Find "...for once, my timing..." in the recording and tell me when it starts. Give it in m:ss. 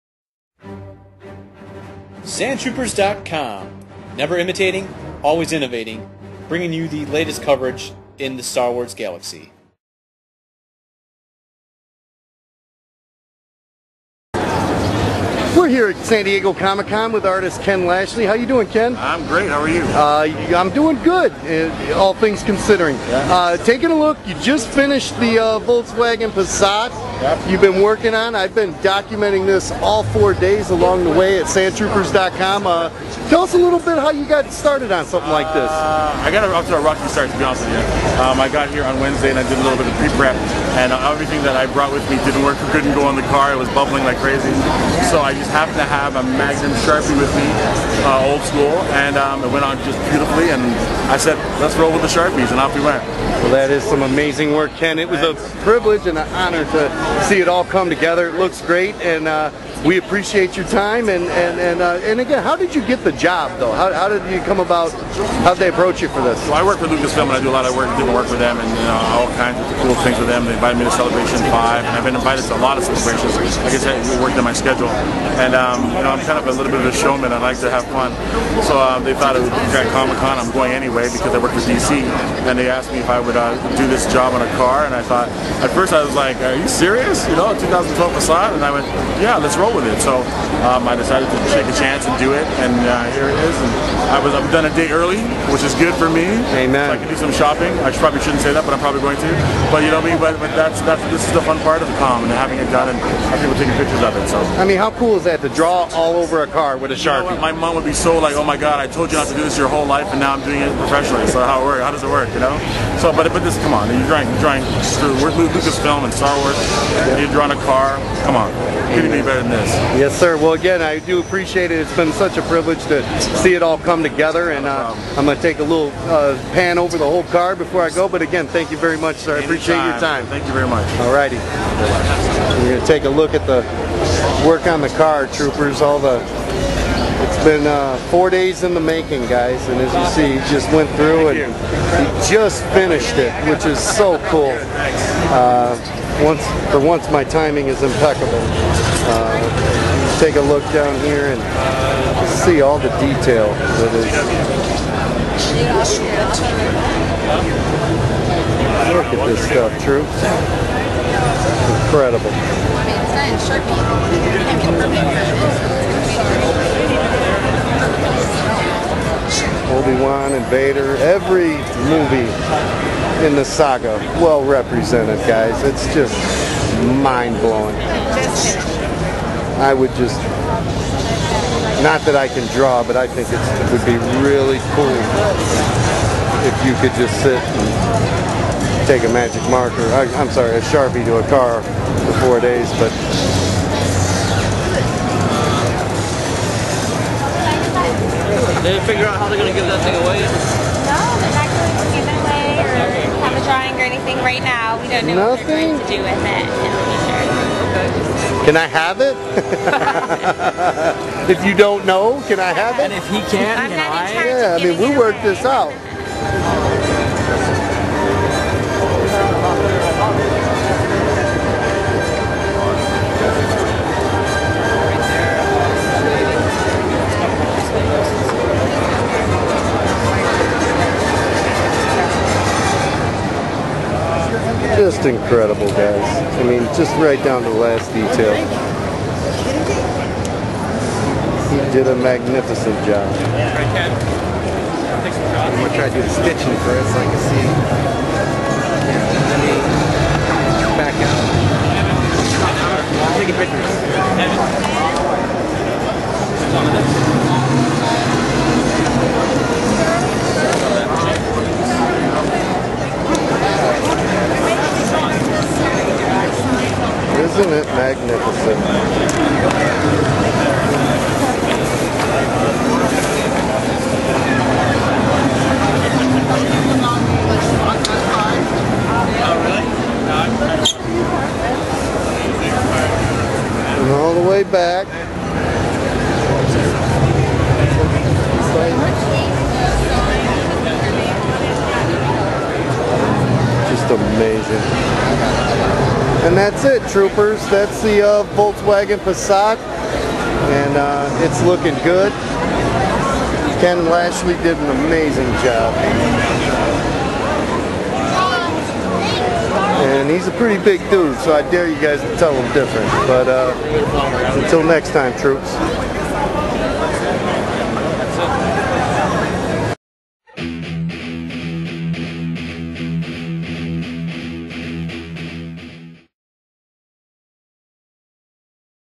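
2:26.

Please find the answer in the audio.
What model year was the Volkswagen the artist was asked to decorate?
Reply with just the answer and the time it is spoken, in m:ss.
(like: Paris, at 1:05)
2012, at 1:27.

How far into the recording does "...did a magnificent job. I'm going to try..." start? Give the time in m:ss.
4:01.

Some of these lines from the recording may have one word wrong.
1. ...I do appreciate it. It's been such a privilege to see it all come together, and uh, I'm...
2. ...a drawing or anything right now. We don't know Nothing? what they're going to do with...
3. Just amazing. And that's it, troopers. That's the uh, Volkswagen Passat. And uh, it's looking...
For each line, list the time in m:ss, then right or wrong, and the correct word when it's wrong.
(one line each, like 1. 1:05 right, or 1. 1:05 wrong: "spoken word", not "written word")
1. 2:00 right
2. 3:23 right
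3. 4:53 right.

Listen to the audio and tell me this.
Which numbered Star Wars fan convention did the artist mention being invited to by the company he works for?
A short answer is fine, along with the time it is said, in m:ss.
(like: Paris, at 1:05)
Celebration 5, at 1:10.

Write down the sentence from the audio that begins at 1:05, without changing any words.
how did they approach you for this?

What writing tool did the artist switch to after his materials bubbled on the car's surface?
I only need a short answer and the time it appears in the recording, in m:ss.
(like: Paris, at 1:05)
Magnum Sharpie, at 0:46.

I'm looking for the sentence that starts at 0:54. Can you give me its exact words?
It was a privilege and an honor to see it all come together.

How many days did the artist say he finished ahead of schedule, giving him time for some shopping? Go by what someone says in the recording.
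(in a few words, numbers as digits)
1 day.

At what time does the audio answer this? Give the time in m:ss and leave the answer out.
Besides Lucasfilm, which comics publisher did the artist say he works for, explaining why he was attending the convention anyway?
1:21.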